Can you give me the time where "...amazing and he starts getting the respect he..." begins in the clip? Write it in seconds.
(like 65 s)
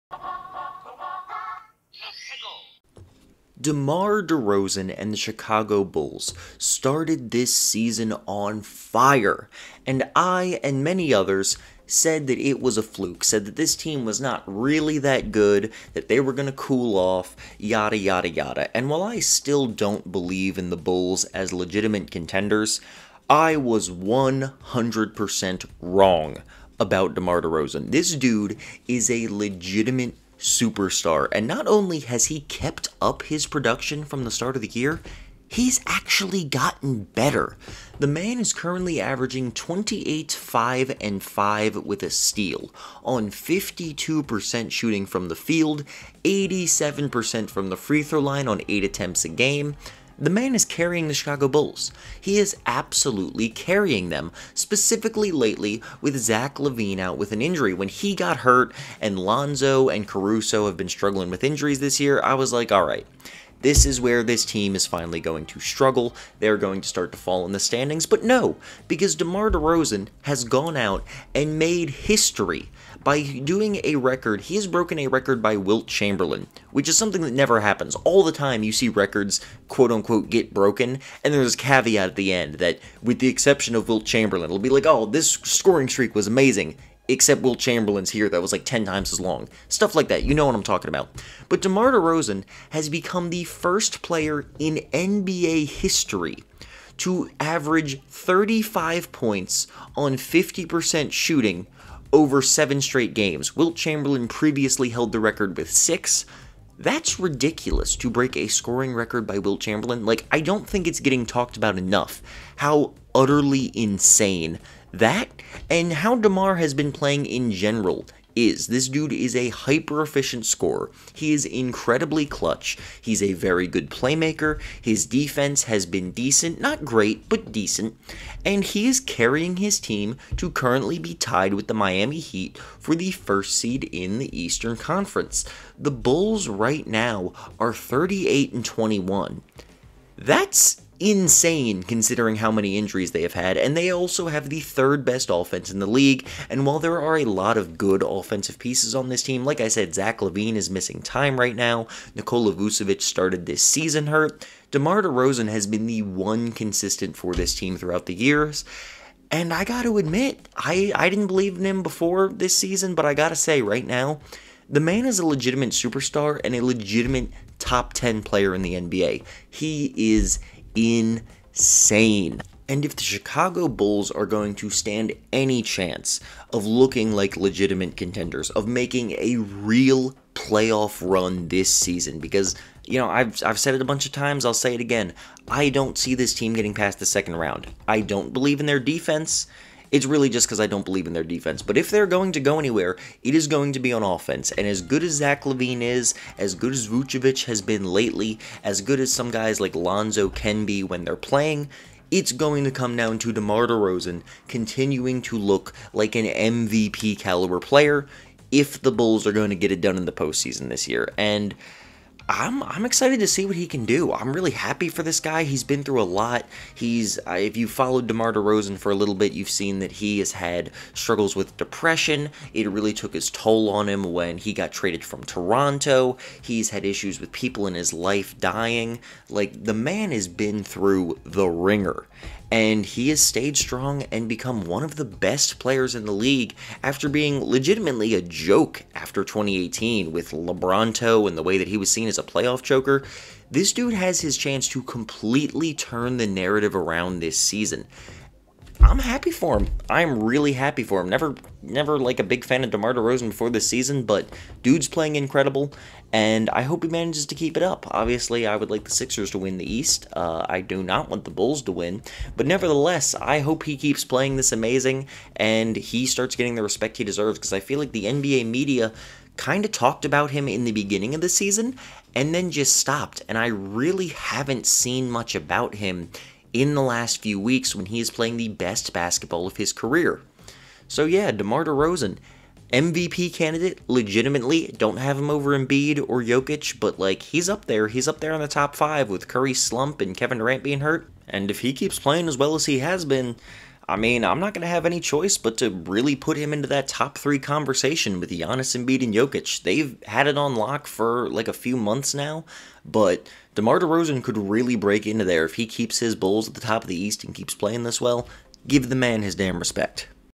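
264 s.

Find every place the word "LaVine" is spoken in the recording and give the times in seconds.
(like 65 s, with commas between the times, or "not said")
56 s, 150 s, 195 s.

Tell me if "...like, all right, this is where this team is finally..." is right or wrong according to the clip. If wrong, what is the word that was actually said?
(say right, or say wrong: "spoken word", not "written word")
right.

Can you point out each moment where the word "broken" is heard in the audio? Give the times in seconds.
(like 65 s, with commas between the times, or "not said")
74 s, 80 s.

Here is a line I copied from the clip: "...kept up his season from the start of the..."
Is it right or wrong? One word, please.
wrong.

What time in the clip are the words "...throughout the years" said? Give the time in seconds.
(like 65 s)
157 s.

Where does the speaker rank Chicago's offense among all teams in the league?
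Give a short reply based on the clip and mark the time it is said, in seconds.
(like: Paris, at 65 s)
Third best, at 144 s.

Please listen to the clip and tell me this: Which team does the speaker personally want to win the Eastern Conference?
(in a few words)
Sixers.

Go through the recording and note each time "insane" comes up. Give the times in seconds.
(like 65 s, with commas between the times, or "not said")
113 s, 141 s, 170 s.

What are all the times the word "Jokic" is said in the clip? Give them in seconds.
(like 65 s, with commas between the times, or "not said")
286 s, 299 s.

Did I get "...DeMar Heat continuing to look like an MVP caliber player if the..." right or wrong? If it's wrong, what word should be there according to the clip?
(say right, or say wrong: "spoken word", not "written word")
wrong: "DeRozan", not "Heat".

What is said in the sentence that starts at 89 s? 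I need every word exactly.
Stuff like that, you know what I'm talking about.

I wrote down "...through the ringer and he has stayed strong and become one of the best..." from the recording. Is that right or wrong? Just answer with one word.
right.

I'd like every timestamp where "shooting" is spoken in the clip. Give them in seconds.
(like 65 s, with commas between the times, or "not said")
44 s, 101 s.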